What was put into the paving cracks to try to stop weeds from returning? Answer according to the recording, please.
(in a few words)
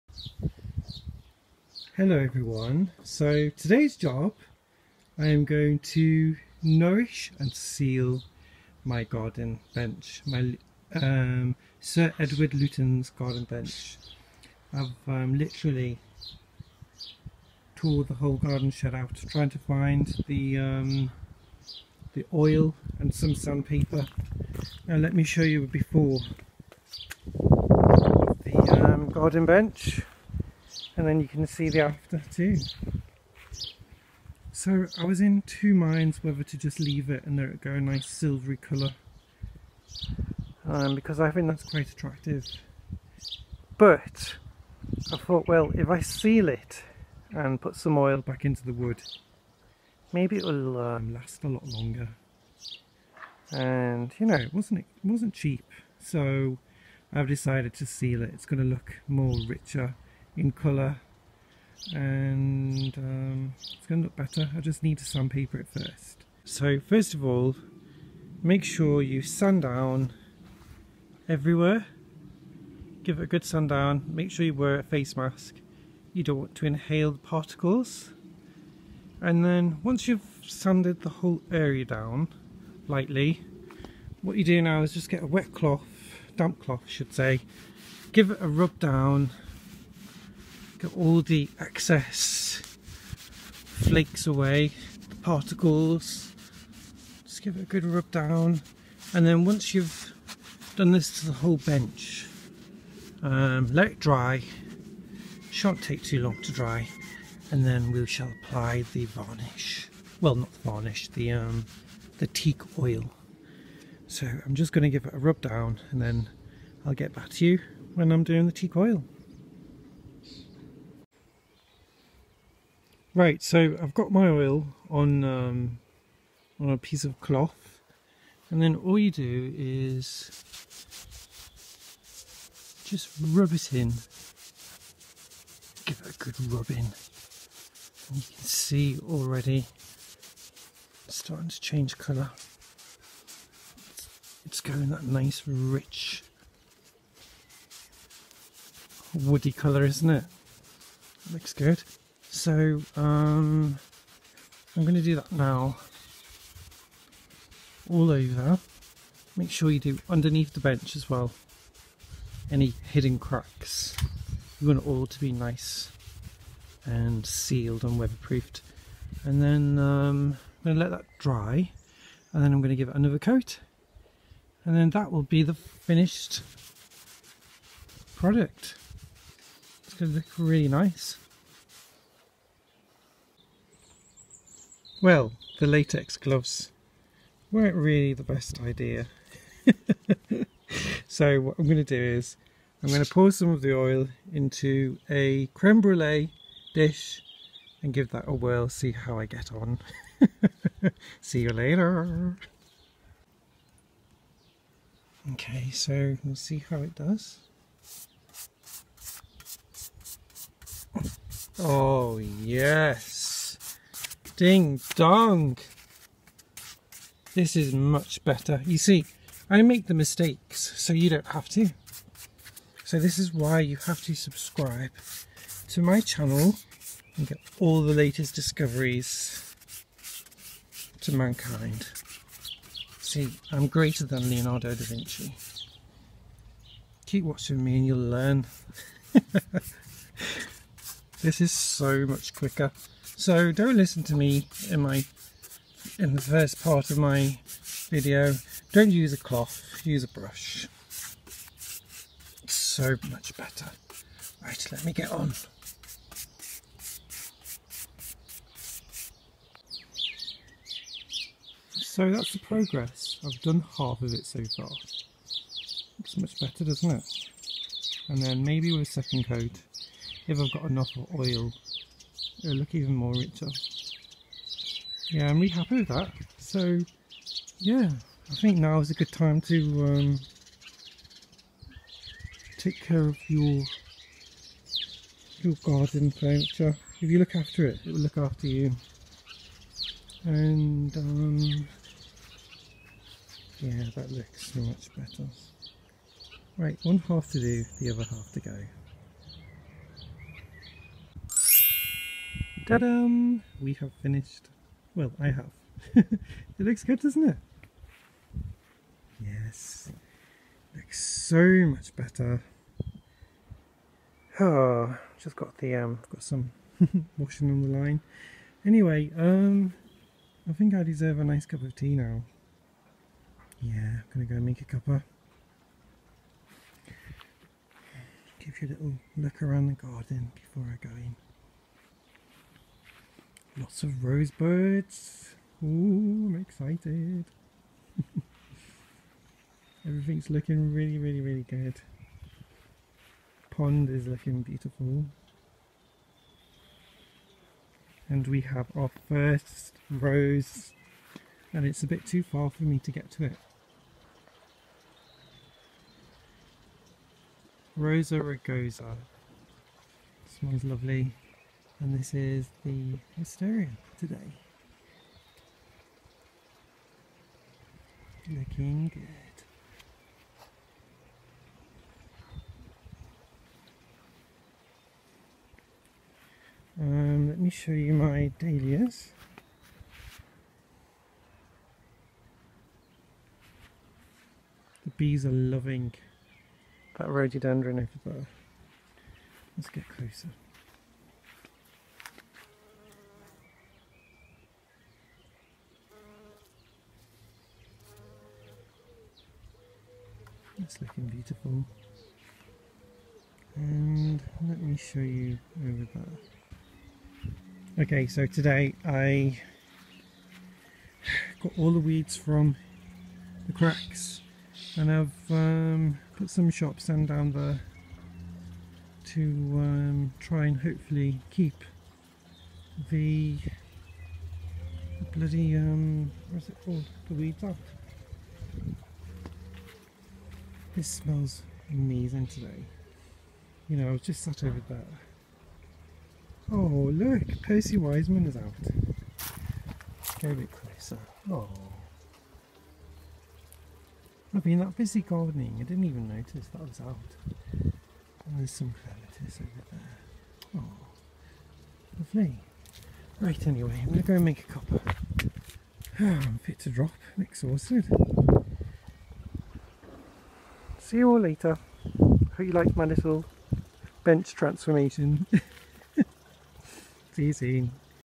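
Shop sand.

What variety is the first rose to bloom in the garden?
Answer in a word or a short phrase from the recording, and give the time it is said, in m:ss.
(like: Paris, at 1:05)
Rosa rugosa, at 5:57.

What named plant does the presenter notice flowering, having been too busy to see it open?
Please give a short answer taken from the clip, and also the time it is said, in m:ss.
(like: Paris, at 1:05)
Percy Wiseman, at 7:17.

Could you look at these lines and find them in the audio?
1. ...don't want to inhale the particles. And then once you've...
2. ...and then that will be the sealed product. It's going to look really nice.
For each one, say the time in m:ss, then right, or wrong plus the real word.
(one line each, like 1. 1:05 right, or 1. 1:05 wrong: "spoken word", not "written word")
1. 1:16 right
2. 2:54 wrong: "finished", not "sealed".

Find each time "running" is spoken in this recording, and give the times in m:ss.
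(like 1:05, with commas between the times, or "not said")
not said.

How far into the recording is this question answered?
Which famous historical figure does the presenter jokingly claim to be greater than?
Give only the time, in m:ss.
3:54.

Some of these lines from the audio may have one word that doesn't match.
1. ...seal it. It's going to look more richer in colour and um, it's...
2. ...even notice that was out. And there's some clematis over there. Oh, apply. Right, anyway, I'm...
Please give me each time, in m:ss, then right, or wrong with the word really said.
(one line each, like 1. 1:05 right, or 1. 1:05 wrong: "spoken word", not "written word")
1. 0:57 right
2. 7:25 wrong: "lovely", not "apply".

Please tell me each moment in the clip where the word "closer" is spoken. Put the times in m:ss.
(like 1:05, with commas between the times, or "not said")
6:29, 7:20.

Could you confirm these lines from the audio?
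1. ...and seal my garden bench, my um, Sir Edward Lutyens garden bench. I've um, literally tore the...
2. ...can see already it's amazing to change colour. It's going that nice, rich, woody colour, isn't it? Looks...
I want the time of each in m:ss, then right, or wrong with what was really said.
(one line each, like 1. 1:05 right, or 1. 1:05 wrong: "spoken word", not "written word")
1. 0:07 right
2. 2:18 wrong: "starting", not "amazing".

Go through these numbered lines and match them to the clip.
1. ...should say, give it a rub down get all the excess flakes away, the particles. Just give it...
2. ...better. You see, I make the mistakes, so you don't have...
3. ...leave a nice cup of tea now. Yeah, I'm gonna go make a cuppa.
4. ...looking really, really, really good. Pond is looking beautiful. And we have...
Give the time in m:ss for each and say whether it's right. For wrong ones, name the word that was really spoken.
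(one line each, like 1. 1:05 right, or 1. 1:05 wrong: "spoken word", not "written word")
1. 1:26 right
2. 3:38 right
3. 5:20 wrong: "deserve", not "leave"
4. 5:40 right.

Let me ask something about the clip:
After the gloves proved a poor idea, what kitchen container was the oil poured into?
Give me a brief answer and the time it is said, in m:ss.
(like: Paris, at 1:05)
Creme brulee dish, at 3:15.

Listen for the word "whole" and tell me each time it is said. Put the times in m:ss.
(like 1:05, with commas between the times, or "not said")
0:18, 1:21, 1:41.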